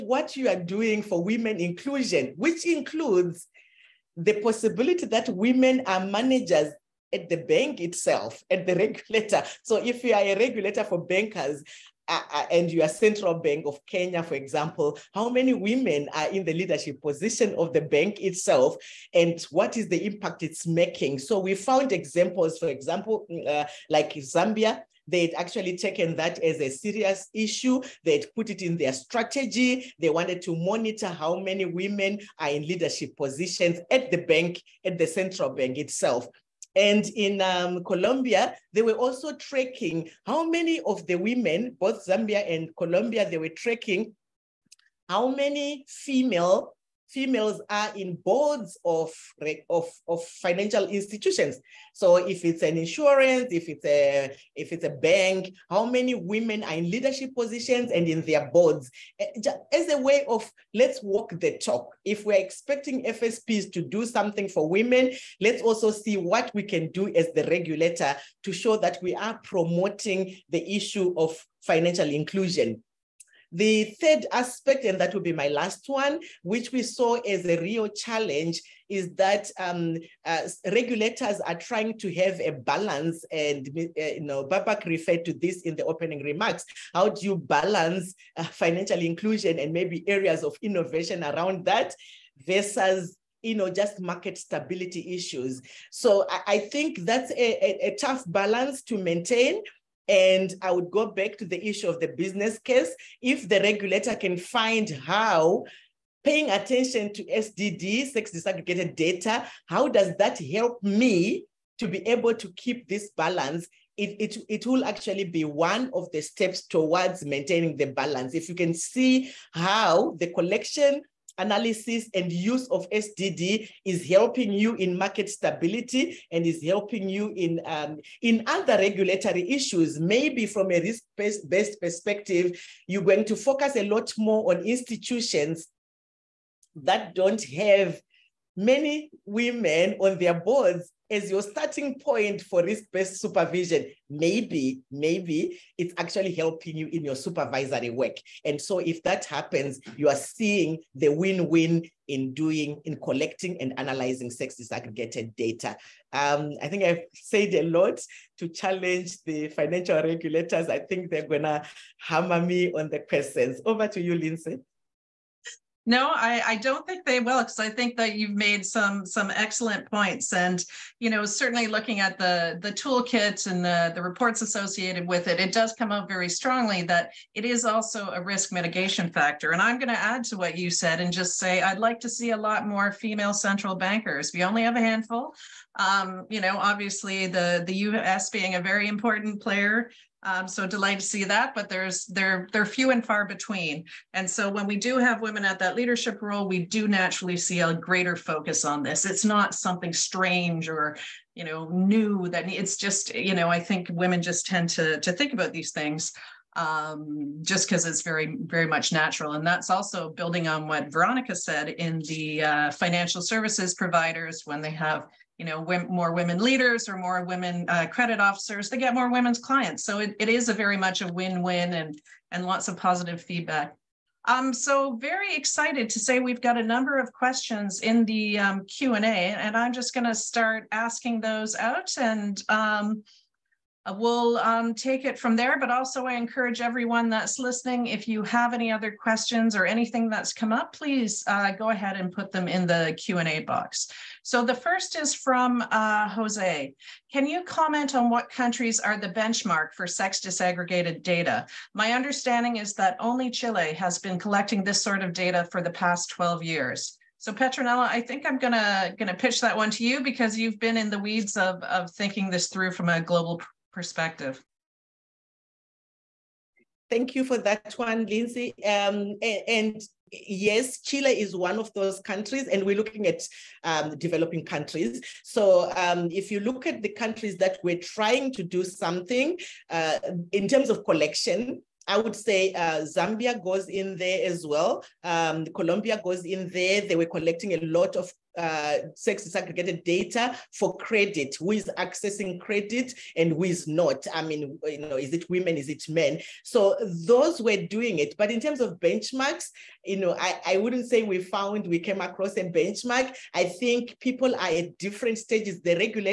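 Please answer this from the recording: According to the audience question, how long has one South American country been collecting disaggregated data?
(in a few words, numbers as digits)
12 years.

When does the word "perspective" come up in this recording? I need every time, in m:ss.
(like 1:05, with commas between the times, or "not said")
2:11, 4:23.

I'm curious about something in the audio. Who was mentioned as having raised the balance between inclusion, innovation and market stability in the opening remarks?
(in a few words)
Babak.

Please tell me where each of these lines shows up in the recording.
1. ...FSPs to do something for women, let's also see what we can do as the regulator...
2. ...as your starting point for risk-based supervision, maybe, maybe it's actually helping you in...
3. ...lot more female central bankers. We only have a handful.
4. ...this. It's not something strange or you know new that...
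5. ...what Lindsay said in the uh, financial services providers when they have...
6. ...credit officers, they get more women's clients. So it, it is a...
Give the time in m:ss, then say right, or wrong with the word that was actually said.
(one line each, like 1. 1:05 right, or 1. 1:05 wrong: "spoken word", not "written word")
1. 1:03 right
2. 2:21 right
3. 3:02 right
4. 3:18 right
5. 3:30 wrong: "Veronica", not "Lindsay"
6. 3:37 right.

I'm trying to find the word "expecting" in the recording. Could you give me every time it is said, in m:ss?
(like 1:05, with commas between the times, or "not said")
1:02.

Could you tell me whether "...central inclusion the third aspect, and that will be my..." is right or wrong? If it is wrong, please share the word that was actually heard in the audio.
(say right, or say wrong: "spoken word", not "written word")
wrong: "financial", not "central".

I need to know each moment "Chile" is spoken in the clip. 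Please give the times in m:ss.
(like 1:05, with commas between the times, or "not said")
4:13, 4:30.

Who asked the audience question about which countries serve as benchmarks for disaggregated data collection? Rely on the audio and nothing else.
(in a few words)
Jose.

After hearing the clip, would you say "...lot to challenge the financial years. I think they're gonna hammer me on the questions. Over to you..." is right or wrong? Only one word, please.
wrong.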